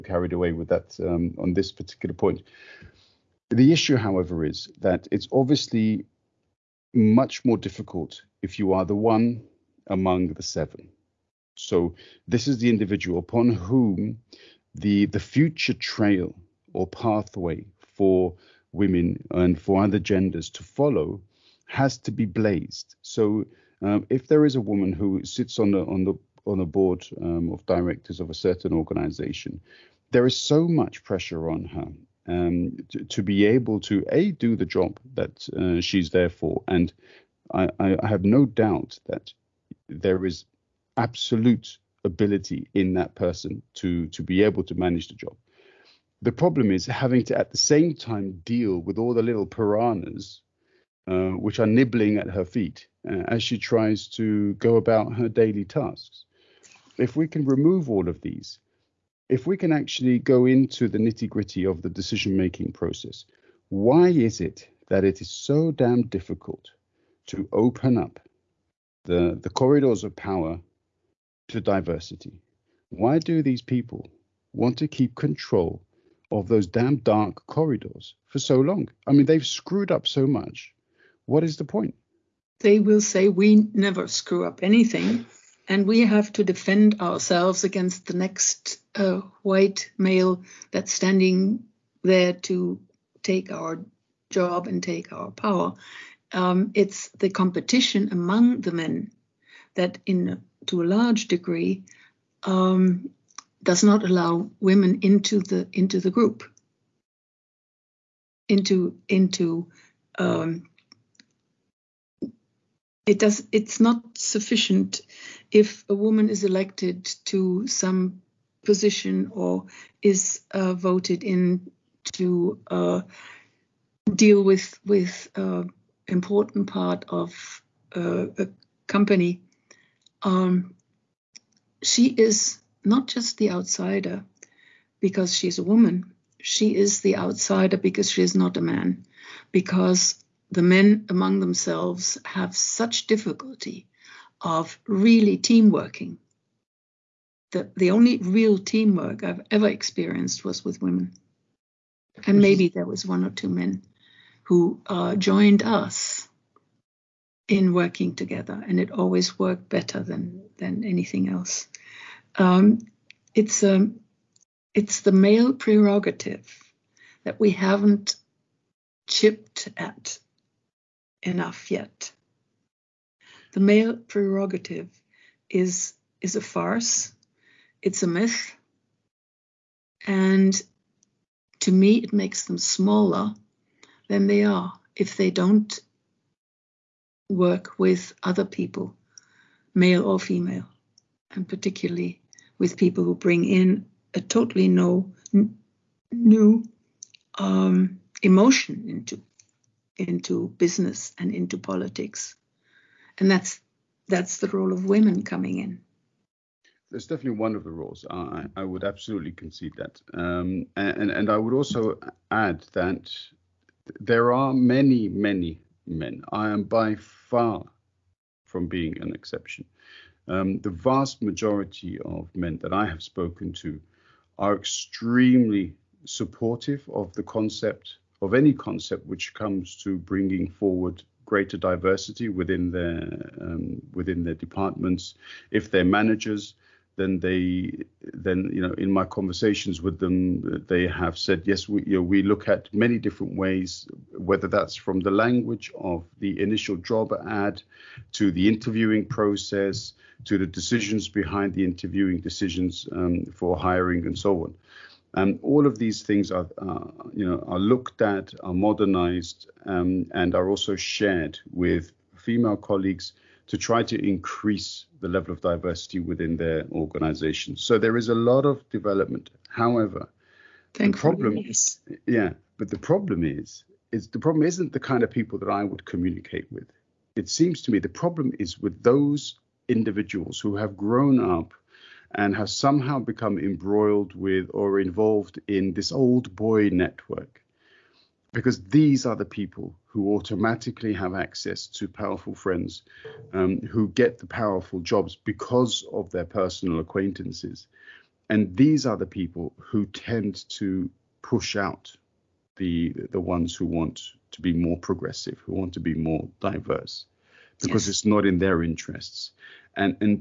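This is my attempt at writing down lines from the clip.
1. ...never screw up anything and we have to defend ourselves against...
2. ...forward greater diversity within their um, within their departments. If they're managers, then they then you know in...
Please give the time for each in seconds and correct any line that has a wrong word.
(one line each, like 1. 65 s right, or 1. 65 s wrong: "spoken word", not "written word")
1. 83 s right
2. 230 s right.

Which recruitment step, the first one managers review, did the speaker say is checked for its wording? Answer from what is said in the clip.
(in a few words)
initial job ad.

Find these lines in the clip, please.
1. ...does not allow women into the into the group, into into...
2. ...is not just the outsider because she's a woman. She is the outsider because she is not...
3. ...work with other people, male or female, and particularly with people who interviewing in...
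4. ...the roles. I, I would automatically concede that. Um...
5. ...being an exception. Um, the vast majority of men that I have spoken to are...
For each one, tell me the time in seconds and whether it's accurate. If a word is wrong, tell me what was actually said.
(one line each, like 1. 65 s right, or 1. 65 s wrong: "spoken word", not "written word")
1. 103 s right
2. 132 s right
3. 187 s wrong: "bring", not "interviewing"
4. 207 s wrong: "absolutely", not "automatically"
5. 218 s right.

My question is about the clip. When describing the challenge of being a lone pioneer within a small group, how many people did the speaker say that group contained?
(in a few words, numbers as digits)
7.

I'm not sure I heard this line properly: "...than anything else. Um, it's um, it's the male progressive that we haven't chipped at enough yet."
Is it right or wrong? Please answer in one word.
wrong.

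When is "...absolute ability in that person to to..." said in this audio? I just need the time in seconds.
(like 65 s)
40 s.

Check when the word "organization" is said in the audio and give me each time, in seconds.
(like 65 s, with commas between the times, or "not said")
28 s, 266 s.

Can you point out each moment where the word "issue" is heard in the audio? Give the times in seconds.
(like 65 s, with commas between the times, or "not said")
3 s.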